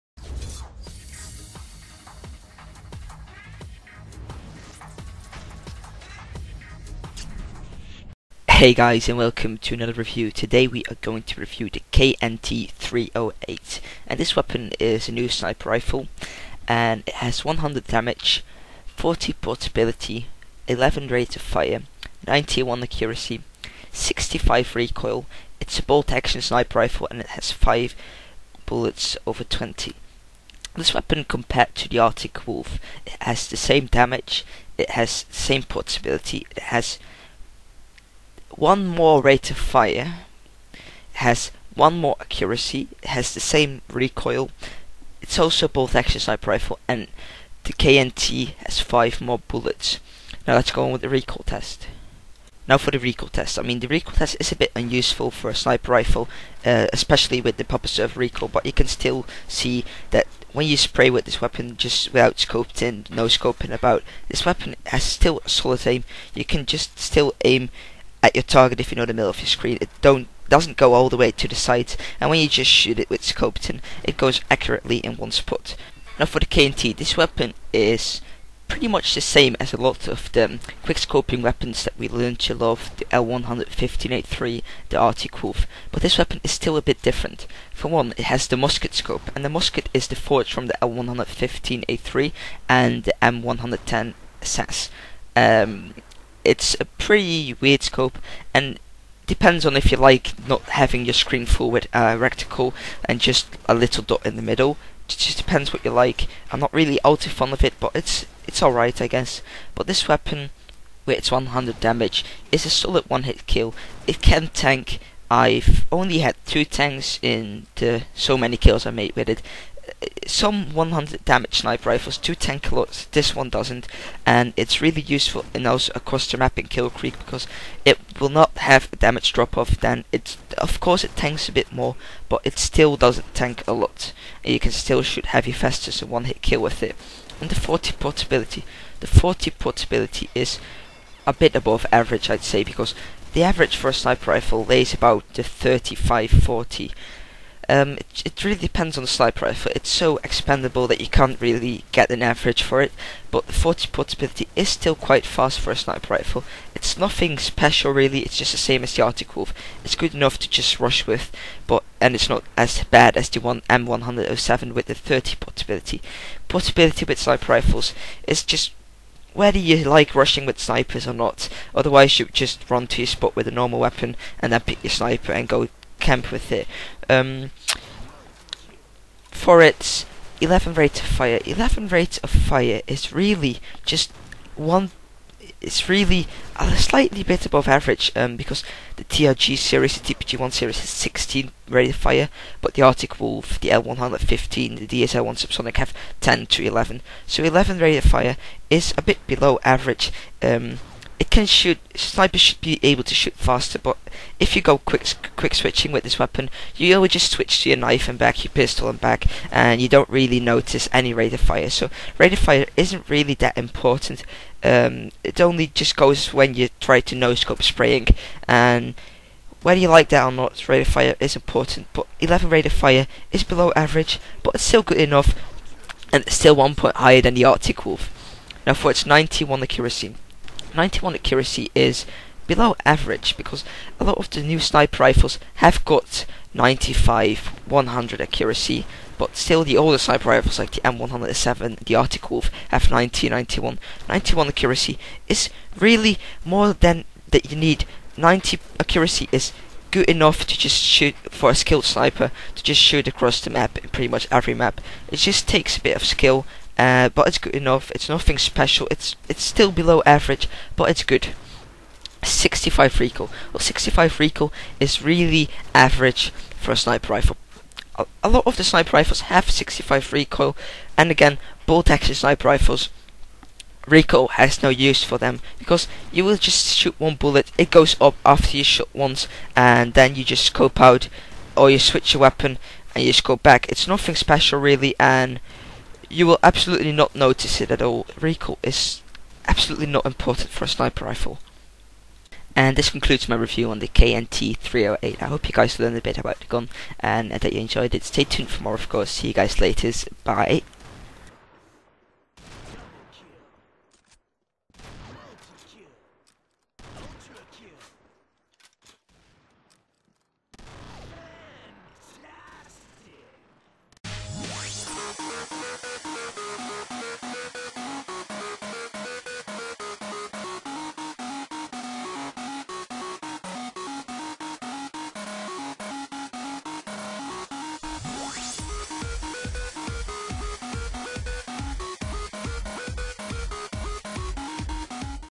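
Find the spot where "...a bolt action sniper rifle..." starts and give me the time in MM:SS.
00:25.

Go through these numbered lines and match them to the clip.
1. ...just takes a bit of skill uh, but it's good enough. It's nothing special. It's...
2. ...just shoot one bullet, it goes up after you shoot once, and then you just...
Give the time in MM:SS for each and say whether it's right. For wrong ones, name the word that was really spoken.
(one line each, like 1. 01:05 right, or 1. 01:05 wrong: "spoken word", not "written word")
1. 04:15 right
2. 04:36 right.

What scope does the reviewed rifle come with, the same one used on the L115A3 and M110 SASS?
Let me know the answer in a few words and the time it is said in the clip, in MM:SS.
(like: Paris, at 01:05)
musket scope, at 01:28.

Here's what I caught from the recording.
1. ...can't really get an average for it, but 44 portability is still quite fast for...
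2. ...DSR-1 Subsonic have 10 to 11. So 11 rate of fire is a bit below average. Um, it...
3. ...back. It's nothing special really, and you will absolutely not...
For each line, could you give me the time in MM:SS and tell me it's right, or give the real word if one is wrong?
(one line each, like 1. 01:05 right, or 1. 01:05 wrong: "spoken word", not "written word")
1. 02:31 wrong: "40", not "44"
2. 03:15 right
3. 04:43 right.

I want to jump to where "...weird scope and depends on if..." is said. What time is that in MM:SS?
01:37.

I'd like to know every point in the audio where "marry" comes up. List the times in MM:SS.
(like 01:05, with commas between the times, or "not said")
not said.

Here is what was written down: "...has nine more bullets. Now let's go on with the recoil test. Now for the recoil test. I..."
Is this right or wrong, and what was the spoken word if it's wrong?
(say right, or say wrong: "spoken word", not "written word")
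wrong: "five", not "nine".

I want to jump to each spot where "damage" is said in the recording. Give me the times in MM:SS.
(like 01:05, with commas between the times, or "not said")
00:17, 00:33, 01:51, 02:01, 02:08.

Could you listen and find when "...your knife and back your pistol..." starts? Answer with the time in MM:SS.
03:27.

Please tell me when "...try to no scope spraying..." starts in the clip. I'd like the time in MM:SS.
03:36.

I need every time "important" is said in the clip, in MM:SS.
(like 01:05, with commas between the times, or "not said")
03:33, 03:41, 04:50.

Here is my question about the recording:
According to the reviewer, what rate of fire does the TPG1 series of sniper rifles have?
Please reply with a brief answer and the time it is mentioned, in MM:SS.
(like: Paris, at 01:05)
16, at 03:10.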